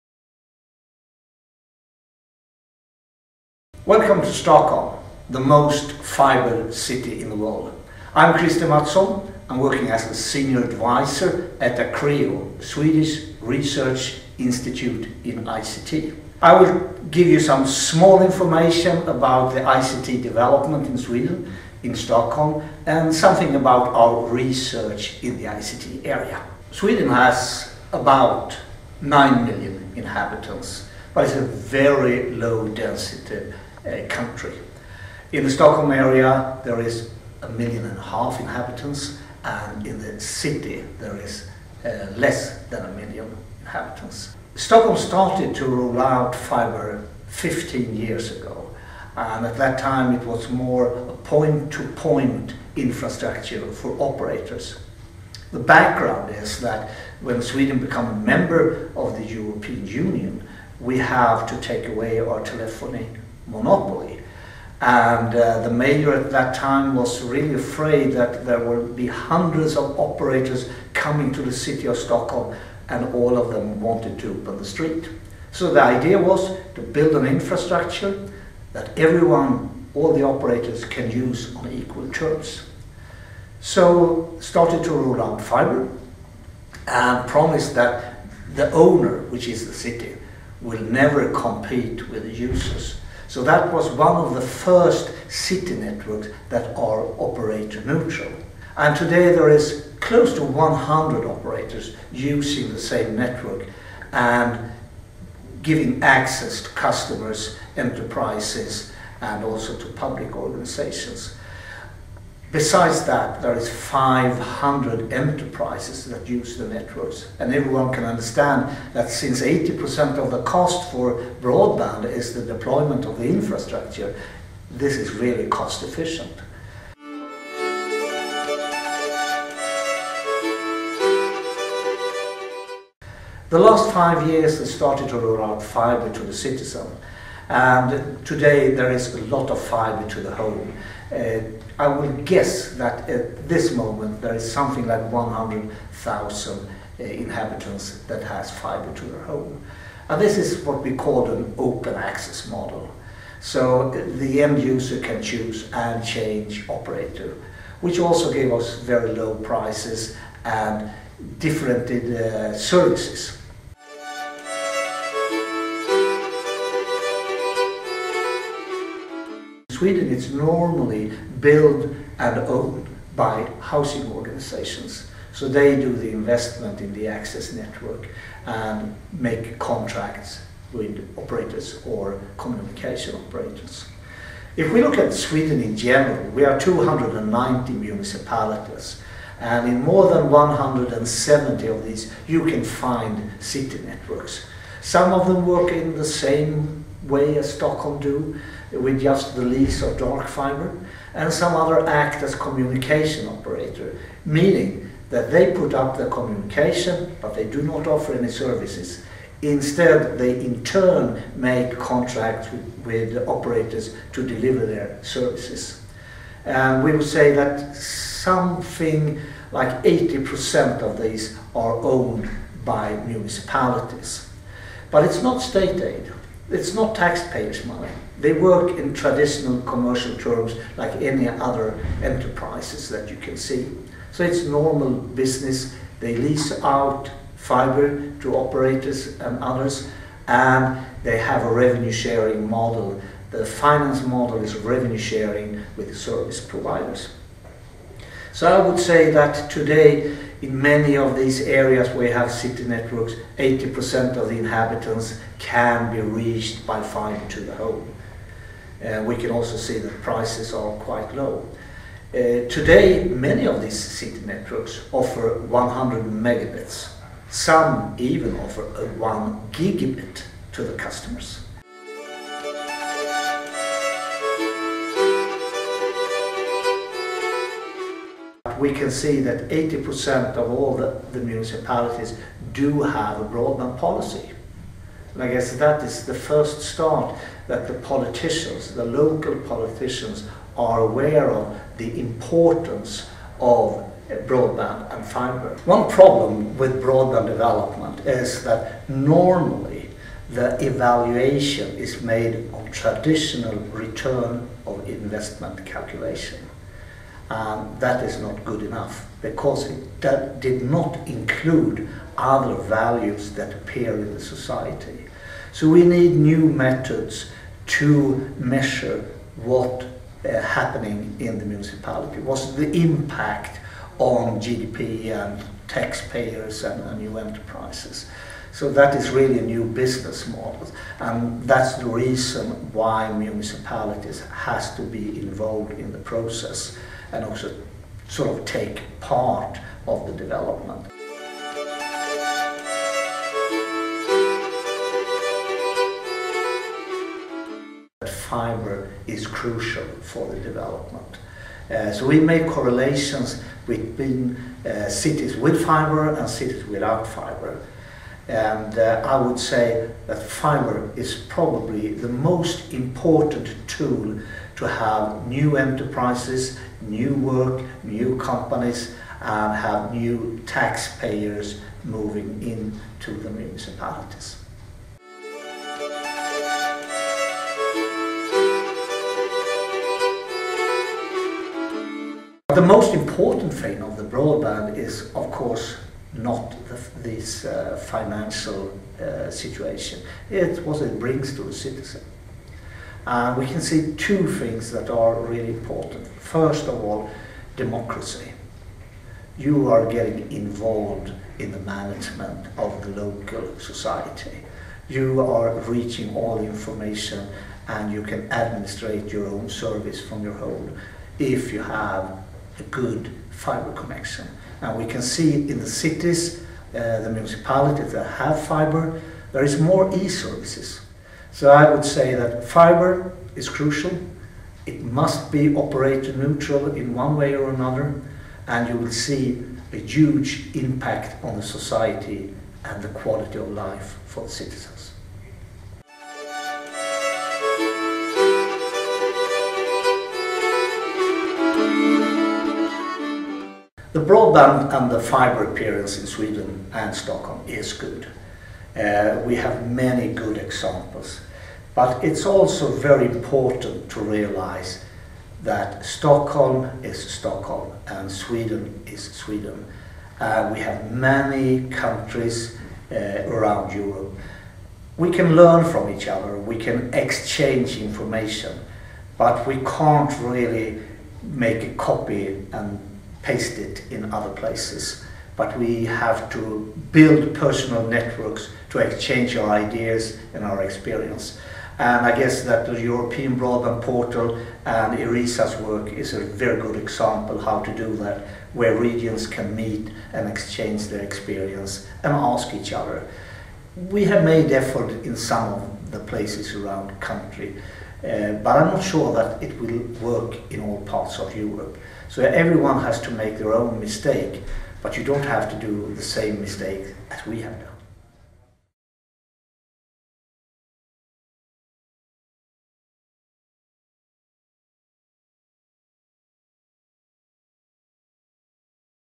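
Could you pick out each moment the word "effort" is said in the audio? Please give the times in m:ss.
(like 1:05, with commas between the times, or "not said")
8:14.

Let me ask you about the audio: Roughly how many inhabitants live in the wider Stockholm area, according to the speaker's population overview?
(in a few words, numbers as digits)
a million and a half.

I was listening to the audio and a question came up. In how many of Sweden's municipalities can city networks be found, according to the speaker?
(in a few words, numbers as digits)
more than 170.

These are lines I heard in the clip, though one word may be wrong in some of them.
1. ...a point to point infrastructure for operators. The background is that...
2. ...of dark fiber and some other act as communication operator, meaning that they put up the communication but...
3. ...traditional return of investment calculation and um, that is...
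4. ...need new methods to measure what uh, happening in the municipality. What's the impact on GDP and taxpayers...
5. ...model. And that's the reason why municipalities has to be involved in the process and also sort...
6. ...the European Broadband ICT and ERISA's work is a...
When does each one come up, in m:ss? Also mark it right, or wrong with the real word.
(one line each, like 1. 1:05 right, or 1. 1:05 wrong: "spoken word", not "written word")
1. 0:51 right
2. 3:19 right
3. 5:02 right
4. 5:15 right
5. 5:30 right
6. 8:02 wrong: "Portal", not "ICT".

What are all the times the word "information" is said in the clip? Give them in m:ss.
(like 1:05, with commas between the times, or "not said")
0:18, 6:46, 7:47.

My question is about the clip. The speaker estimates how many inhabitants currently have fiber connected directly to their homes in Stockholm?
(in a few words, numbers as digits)
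100,000.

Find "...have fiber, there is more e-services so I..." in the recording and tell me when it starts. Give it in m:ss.
6:58.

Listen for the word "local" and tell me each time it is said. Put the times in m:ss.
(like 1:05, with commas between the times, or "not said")
4:48, 6:43.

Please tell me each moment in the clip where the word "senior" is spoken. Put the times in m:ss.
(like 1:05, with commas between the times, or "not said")
0:10.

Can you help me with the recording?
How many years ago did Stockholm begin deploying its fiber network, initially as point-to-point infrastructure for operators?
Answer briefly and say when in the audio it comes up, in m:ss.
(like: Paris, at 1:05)
15, at 0:47.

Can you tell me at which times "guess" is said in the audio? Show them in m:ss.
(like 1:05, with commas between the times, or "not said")
2:22, 4:45, 8:02.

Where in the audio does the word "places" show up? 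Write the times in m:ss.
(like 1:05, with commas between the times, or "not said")
7:54, 8:16.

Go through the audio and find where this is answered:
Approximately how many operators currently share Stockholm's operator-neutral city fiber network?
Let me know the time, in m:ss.
1:40.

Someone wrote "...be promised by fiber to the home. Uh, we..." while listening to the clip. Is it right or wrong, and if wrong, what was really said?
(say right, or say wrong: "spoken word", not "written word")
wrong: "reached", not "promised".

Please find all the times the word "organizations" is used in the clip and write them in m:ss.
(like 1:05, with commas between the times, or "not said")
1:50, 2:54.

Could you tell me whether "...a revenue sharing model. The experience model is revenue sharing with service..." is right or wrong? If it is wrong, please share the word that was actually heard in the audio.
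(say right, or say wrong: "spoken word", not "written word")
wrong: "finance", not "experience".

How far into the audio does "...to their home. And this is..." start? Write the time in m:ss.
2:28.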